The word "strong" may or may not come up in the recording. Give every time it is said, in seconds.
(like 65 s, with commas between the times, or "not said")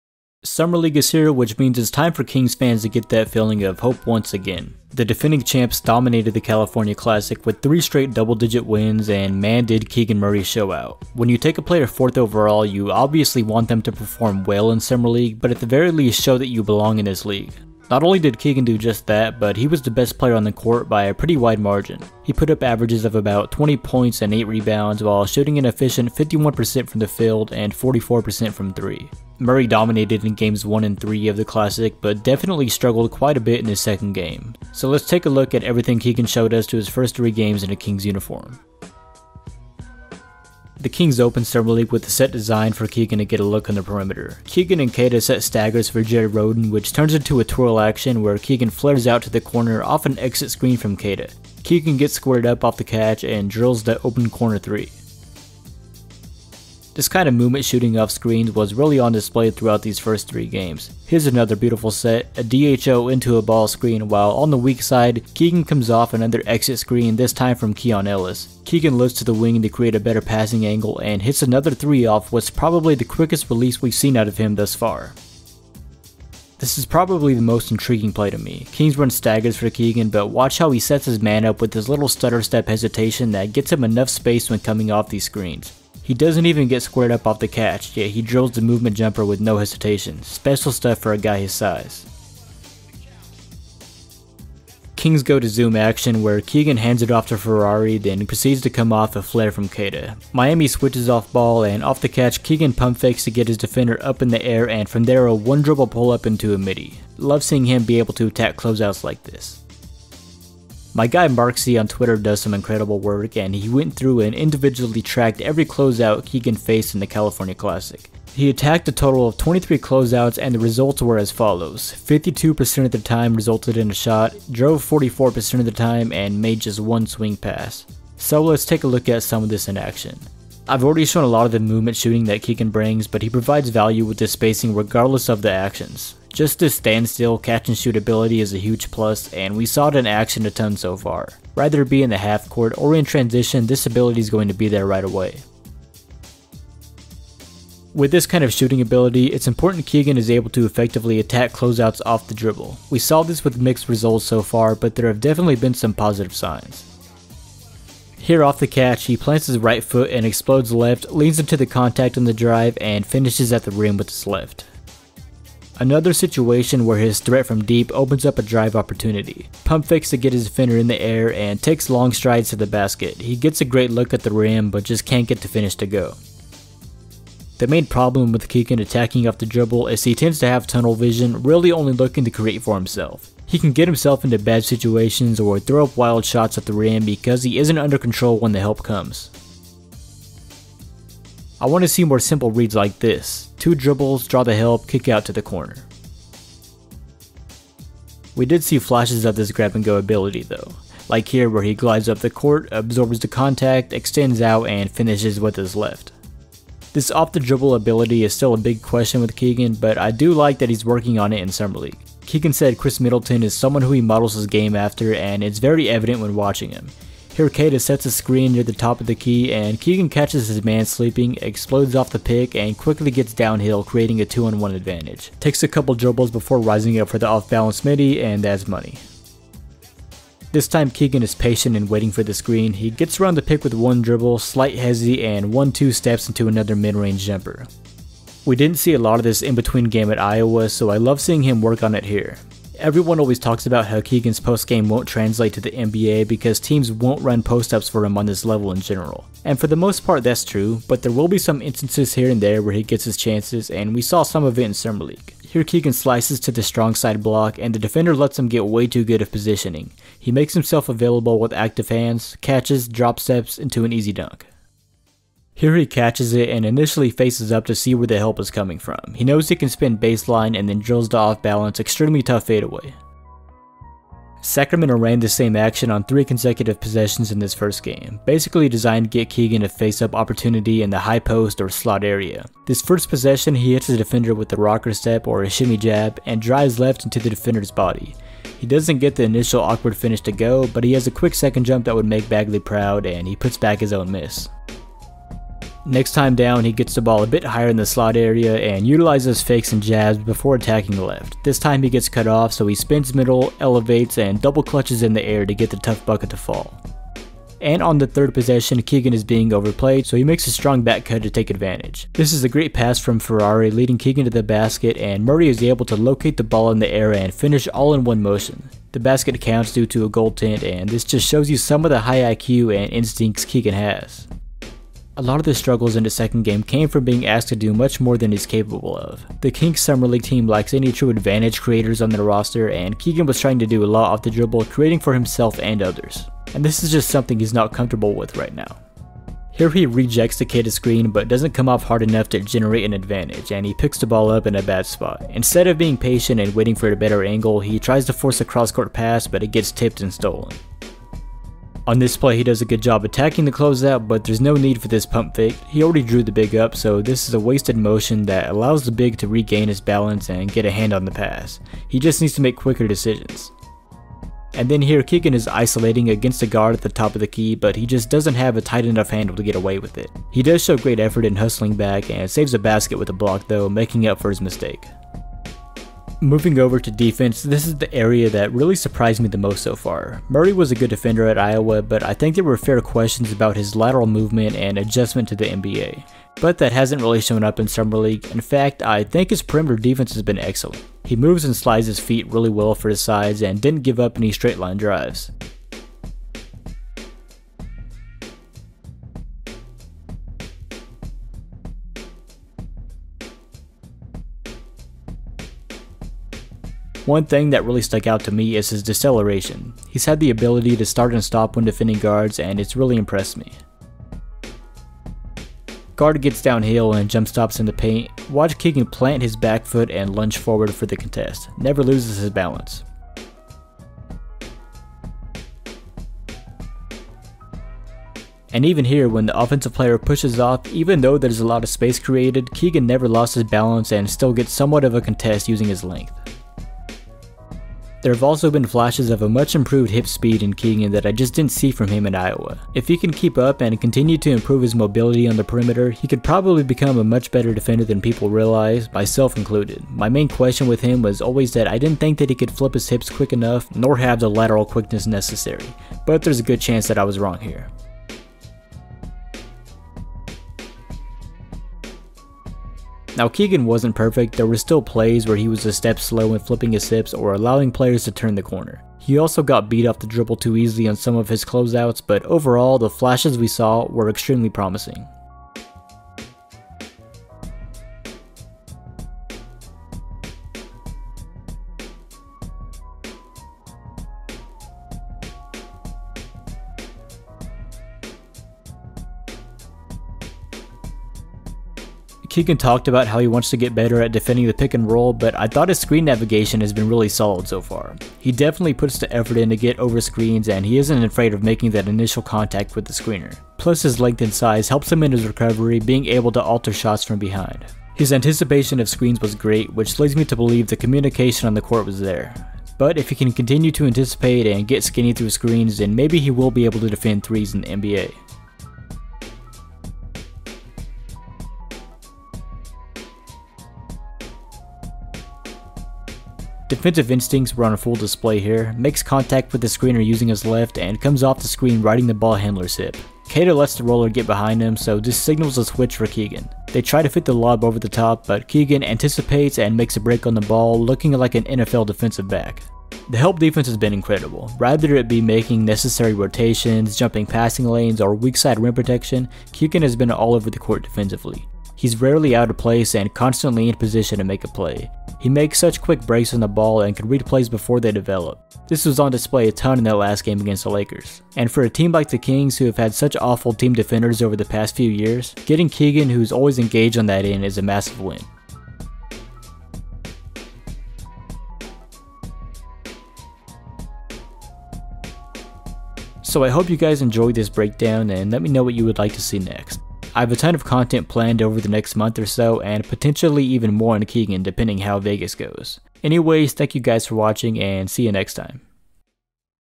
256 s, 310 s.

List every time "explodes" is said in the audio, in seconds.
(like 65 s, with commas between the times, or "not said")
160 s, 221 s.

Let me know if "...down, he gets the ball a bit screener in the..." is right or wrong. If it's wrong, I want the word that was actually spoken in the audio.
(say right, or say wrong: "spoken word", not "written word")
wrong: "higher", not "screener".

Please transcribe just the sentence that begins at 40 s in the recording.
The Kings opened summer league with a set design for Keegan to get a look on the perimeter.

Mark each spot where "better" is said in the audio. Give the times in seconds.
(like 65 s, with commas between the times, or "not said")
70 s, 346 s, 447 s, 493 s.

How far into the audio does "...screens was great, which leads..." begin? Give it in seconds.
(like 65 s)
508 s.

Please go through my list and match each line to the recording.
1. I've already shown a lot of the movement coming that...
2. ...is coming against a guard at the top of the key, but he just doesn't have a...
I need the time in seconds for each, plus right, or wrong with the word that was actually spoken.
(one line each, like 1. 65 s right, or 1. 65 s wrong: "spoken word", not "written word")
1. 130 s wrong: "shooting", not "coming"
2. 365 s wrong: "isolating", not "coming".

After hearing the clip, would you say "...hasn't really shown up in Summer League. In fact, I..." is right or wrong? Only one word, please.
right.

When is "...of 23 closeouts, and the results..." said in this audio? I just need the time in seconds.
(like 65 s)
119 s.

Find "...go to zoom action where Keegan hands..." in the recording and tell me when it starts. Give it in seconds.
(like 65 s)
95 s.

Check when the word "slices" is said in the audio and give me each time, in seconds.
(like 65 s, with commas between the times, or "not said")
255 s.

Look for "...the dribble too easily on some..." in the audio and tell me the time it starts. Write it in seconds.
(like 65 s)
469 s.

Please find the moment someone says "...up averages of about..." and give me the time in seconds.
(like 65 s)
22 s.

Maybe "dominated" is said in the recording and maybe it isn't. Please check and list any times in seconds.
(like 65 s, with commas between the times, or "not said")
5 s, 29 s.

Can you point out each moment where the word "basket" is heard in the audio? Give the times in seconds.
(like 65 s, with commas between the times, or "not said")
172 s, 314 s, 318 s, 372 s.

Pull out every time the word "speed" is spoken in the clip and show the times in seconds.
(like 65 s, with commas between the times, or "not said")
440 s.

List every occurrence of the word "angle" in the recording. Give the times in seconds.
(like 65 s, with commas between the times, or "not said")
70 s, 347 s.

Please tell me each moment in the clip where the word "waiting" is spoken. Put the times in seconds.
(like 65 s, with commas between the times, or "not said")
231 s, 346 s.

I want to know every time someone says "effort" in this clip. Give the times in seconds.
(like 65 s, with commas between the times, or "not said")
370 s, 499 s.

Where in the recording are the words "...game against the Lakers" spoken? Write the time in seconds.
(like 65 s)
560 s.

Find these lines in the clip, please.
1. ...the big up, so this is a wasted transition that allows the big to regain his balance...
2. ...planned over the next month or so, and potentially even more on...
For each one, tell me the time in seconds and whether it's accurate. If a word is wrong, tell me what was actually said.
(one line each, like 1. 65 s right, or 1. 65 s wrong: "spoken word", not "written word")
1. 356 s wrong: "motion", not "transition"
2. 581 s right.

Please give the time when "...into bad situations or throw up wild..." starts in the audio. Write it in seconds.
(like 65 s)
184 s.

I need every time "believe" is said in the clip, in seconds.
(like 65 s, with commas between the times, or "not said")
510 s.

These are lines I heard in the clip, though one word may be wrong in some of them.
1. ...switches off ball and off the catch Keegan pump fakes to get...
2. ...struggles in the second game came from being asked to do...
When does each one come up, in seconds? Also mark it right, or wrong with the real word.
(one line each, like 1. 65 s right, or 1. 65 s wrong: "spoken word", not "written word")
1. 100 s right
2. 325 s right.